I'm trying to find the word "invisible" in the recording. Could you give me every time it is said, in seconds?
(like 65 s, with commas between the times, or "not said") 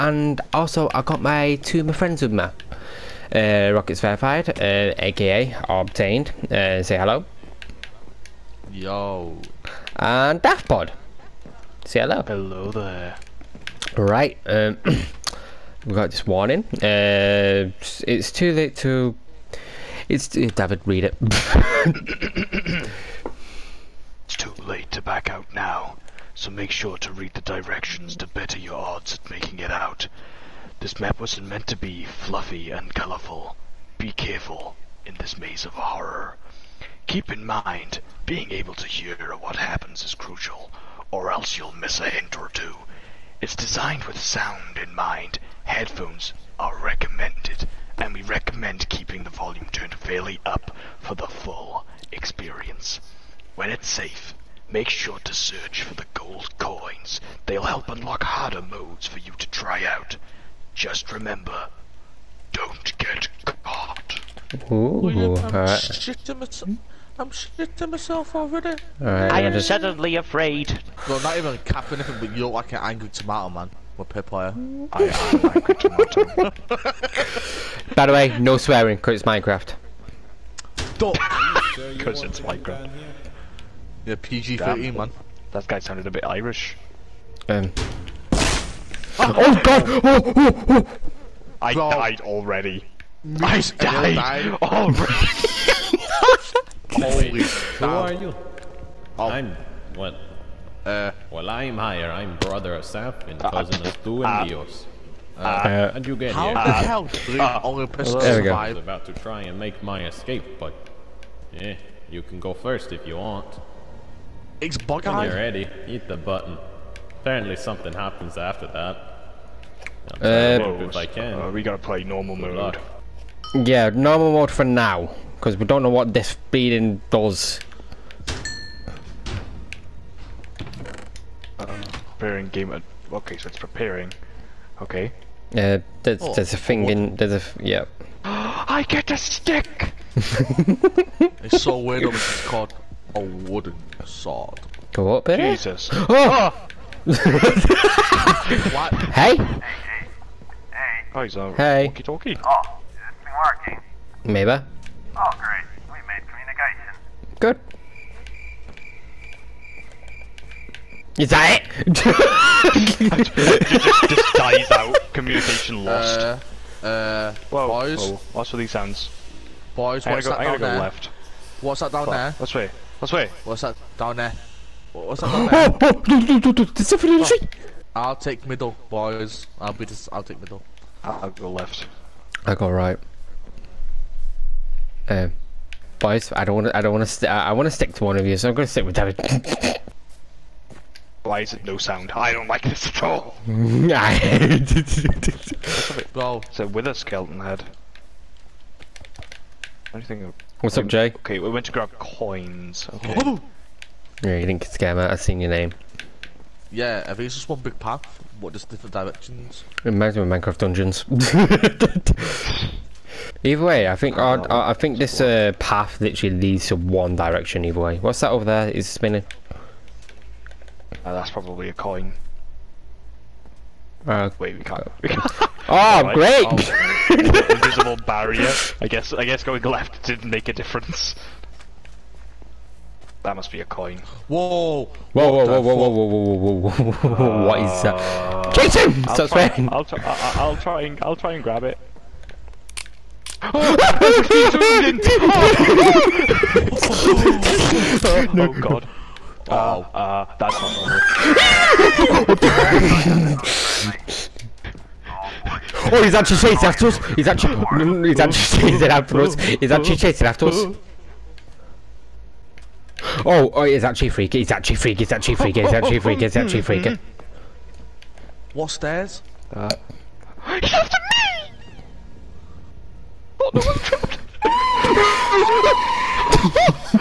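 227 s.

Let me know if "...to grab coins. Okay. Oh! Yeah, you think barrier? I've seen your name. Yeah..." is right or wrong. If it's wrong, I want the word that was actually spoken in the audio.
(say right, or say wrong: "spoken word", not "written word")
wrong: "scammer", not "barrier".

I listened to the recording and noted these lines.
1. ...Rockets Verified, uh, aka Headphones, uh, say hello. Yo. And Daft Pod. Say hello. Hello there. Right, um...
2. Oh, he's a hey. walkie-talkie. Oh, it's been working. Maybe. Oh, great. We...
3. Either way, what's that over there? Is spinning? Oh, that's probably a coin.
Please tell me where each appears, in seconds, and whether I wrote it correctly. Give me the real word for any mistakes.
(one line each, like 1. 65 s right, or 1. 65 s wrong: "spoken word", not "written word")
1. 3 s wrong: "Obtained", not "Headphones"
2. 151 s right
3. 217 s right.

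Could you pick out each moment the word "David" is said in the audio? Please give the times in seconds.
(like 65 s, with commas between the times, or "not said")
20 s, 188 s.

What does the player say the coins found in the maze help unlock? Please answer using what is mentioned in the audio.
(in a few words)
Harder modes.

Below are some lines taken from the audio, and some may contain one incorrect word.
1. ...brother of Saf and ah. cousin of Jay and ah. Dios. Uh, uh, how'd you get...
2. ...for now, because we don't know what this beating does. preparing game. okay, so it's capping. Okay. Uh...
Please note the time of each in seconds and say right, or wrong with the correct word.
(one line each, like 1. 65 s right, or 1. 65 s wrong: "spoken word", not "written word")
1. 102 s wrong: "Stu", not "Jay"
2. 124 s wrong: "preparing", not "capping".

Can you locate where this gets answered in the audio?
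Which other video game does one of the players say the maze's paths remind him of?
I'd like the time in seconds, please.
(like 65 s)
210 s.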